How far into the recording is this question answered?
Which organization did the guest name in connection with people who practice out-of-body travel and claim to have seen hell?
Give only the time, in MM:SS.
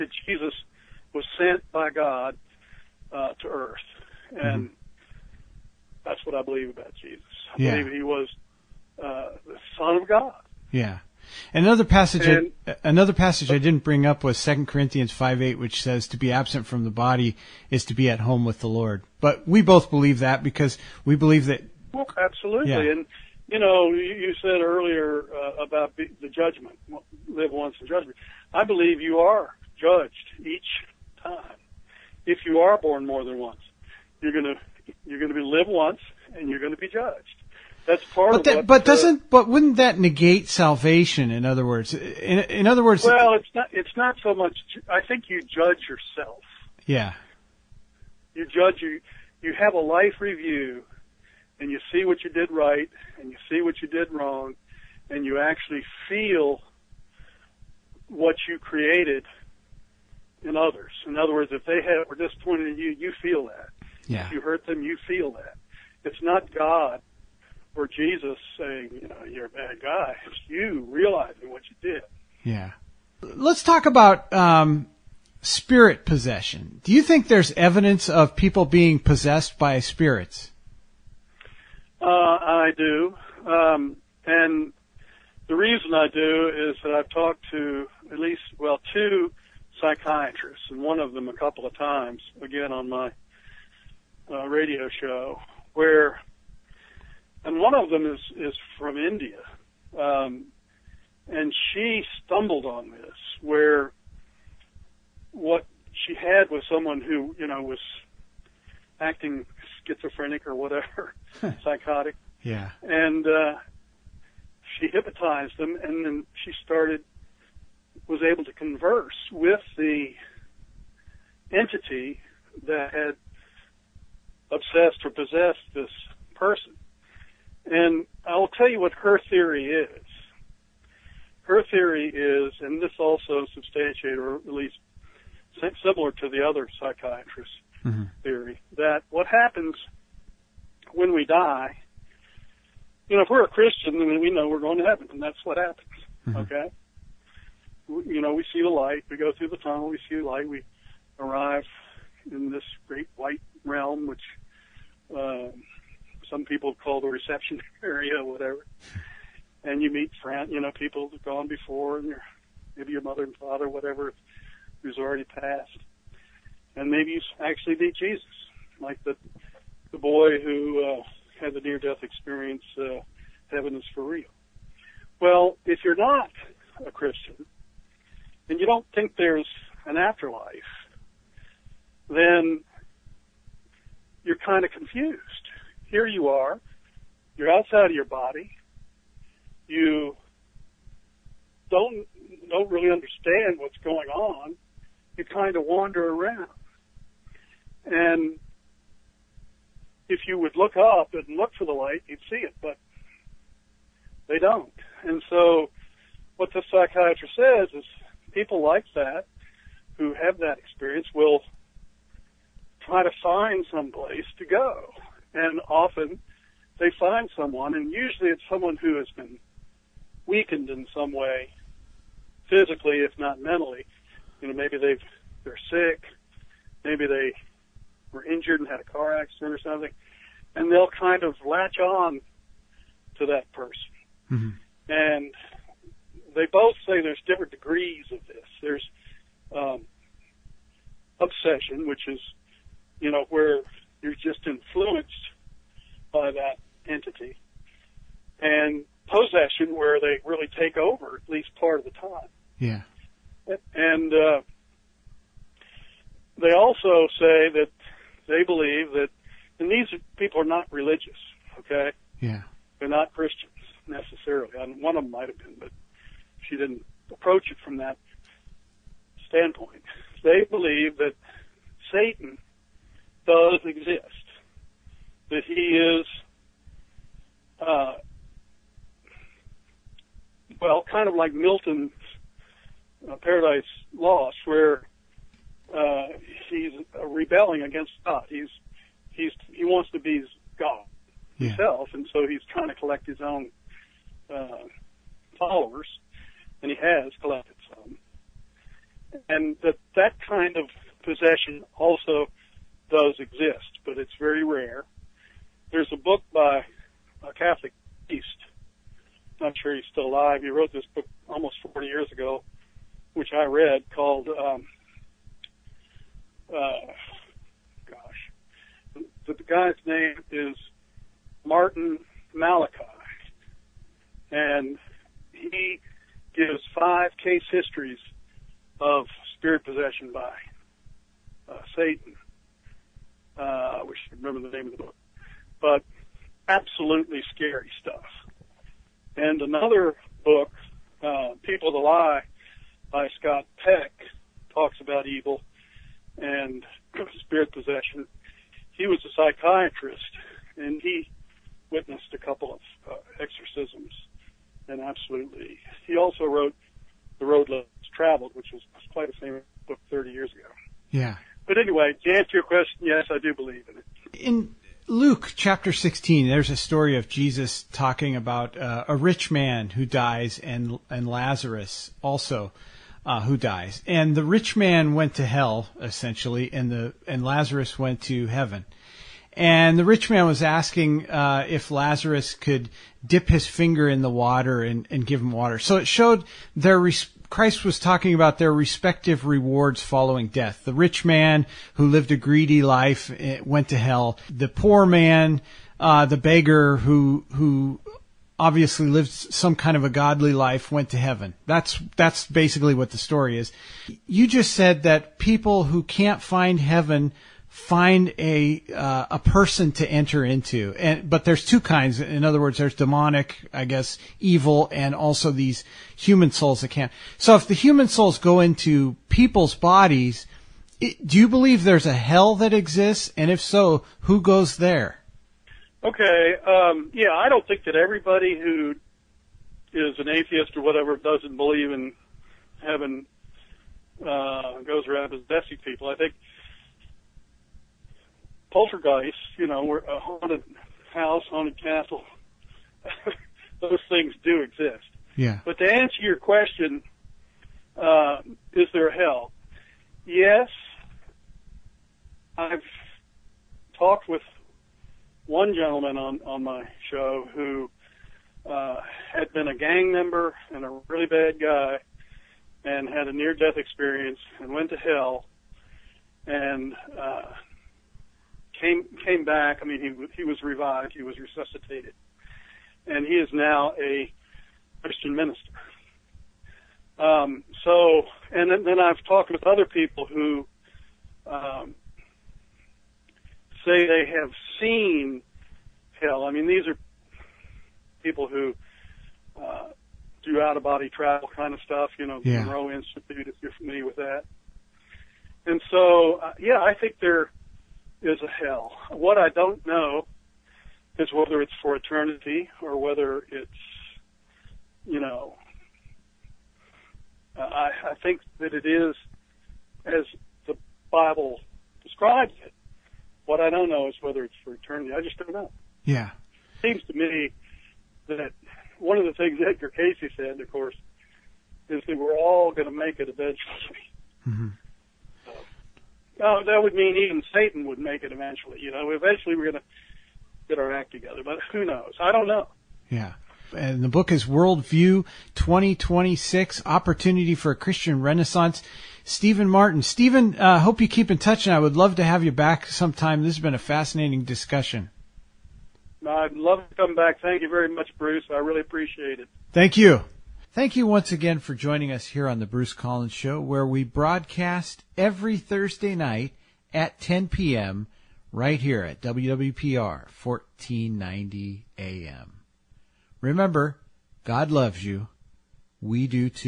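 08:12.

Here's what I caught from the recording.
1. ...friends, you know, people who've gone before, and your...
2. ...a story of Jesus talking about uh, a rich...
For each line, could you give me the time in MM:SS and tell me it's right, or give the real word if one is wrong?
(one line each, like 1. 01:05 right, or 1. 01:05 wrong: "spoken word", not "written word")
1. 02:40 right
2. 06:06 right.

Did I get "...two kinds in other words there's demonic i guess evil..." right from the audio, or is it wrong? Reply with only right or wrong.
right.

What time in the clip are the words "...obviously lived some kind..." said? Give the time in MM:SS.
06:38.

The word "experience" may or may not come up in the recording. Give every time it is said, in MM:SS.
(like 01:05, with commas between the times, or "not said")
02:52, 03:30, 07:43.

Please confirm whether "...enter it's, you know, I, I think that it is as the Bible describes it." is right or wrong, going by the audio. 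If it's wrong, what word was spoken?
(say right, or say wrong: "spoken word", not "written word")
wrong: "whether", not "enter".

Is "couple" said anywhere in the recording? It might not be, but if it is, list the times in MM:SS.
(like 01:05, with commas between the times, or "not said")
01:31, 05:52.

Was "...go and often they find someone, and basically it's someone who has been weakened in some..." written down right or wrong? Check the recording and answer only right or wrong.
wrong.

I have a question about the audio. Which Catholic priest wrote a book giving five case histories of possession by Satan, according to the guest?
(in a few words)
Martin Malachi.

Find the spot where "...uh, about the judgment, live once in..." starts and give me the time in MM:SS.
00:25.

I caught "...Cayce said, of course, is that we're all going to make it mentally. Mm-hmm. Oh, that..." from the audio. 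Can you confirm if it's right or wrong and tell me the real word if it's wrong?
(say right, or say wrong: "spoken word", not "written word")
wrong: "eventually", not "mentally".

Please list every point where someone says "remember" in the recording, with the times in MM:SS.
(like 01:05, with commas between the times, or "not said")
05:34, 09:23.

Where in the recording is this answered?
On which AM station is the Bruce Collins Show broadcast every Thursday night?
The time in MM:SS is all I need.
09:18.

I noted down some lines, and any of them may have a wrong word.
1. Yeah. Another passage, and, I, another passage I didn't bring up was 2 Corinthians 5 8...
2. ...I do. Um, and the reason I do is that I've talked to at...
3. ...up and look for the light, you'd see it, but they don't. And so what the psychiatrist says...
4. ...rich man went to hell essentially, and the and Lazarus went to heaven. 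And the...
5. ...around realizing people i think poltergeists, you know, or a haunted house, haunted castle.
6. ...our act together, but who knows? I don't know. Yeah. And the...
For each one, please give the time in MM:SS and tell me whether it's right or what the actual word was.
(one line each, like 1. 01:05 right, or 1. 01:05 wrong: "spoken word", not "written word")
1. 00:10 right
2. 01:22 right
3. 03:20 right
4. 06:14 right
5. 07:14 wrong: "possessing", not "realizing"
6. 08:50 right.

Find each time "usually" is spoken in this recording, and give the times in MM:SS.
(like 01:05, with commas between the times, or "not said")
03:37.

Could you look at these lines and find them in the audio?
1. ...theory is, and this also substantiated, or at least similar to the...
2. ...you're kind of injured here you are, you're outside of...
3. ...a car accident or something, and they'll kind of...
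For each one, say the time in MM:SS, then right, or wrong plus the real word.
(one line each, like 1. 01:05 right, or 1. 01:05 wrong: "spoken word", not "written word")
1. 02:11 right
2. 03:04 wrong: "confused", not "injured"
3. 03:48 right.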